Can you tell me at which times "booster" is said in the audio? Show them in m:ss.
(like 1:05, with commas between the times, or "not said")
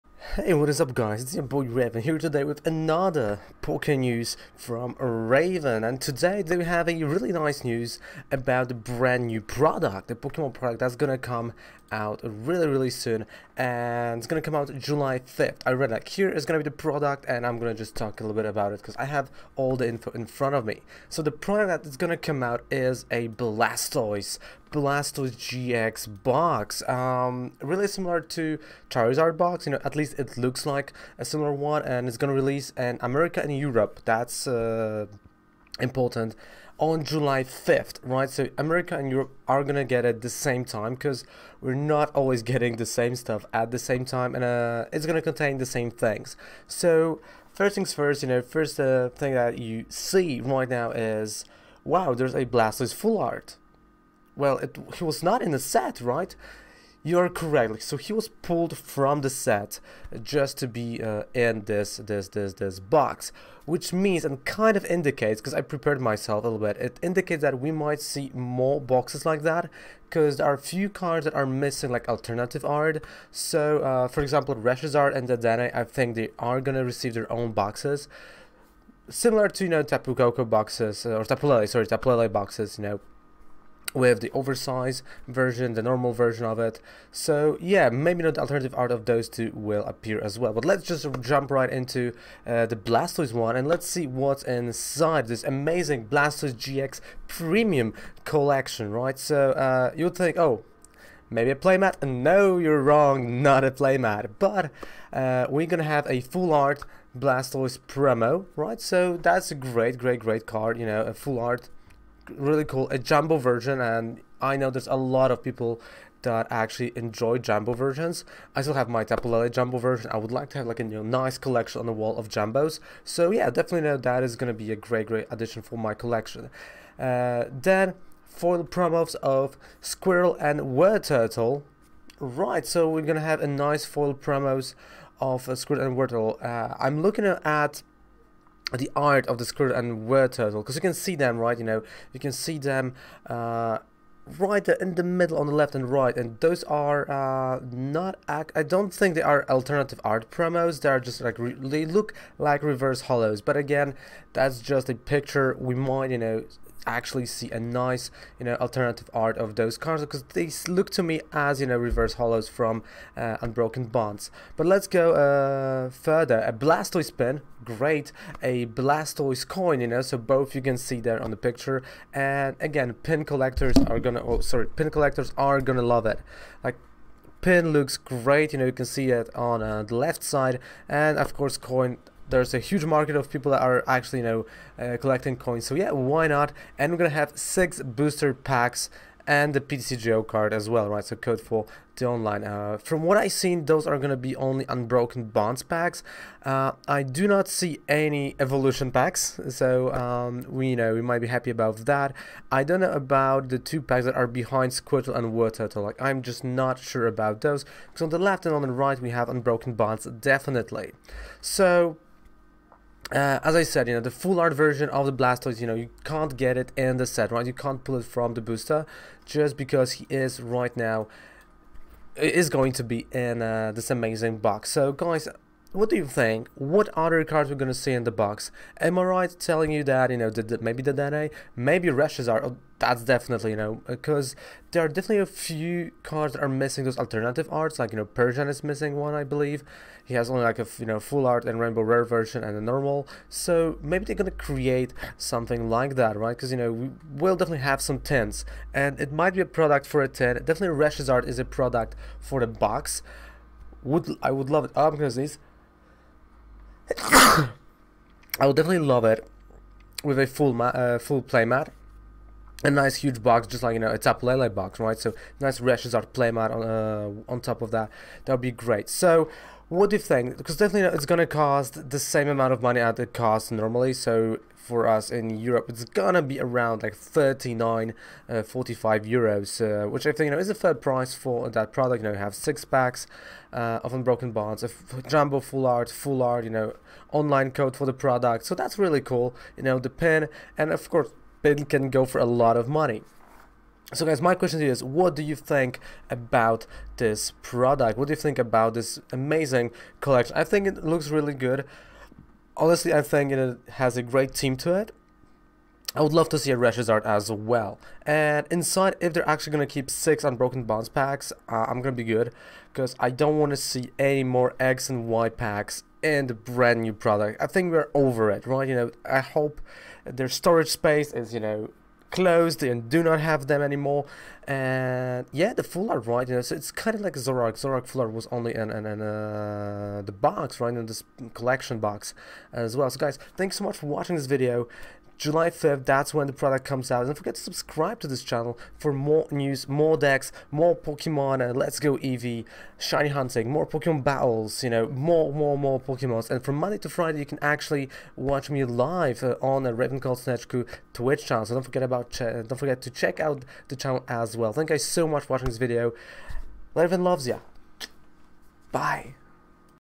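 3:07, 3:38.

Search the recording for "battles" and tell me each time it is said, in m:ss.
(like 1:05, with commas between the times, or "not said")
5:44.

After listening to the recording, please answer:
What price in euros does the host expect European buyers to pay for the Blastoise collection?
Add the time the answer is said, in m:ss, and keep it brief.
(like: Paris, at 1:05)
45 euros, at 4:38.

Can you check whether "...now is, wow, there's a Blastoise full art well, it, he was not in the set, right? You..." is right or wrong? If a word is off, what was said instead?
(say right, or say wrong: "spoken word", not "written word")
right.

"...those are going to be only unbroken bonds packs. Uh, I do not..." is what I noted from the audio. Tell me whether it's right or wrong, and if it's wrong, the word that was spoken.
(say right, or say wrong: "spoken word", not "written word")
right.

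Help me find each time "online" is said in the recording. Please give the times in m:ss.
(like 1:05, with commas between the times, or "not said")
3:12, 4:47.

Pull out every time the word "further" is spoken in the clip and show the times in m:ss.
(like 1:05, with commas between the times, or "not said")
2:45.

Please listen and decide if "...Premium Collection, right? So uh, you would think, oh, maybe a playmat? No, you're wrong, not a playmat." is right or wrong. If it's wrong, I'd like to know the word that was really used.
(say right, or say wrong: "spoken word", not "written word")
right.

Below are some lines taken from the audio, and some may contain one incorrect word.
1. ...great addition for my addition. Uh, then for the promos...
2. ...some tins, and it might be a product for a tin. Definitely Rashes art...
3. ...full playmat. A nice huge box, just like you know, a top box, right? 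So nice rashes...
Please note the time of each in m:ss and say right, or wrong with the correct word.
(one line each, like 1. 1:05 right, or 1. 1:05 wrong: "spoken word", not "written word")
1. 2:05 wrong: "collection", not "addition"
2. 4:07 right
3. 4:20 right.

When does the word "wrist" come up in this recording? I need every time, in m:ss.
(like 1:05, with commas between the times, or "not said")
not said.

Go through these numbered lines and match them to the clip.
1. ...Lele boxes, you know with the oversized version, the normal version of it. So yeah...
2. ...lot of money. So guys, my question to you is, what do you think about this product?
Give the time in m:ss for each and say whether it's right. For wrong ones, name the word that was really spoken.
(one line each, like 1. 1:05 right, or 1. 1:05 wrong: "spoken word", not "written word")
1. 1:22 right
2. 4:52 right.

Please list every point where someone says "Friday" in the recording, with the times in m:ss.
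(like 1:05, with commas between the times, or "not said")
5:46.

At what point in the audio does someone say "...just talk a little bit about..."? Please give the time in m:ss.
0:17.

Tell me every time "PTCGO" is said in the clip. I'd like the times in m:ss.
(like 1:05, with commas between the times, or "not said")
3:09.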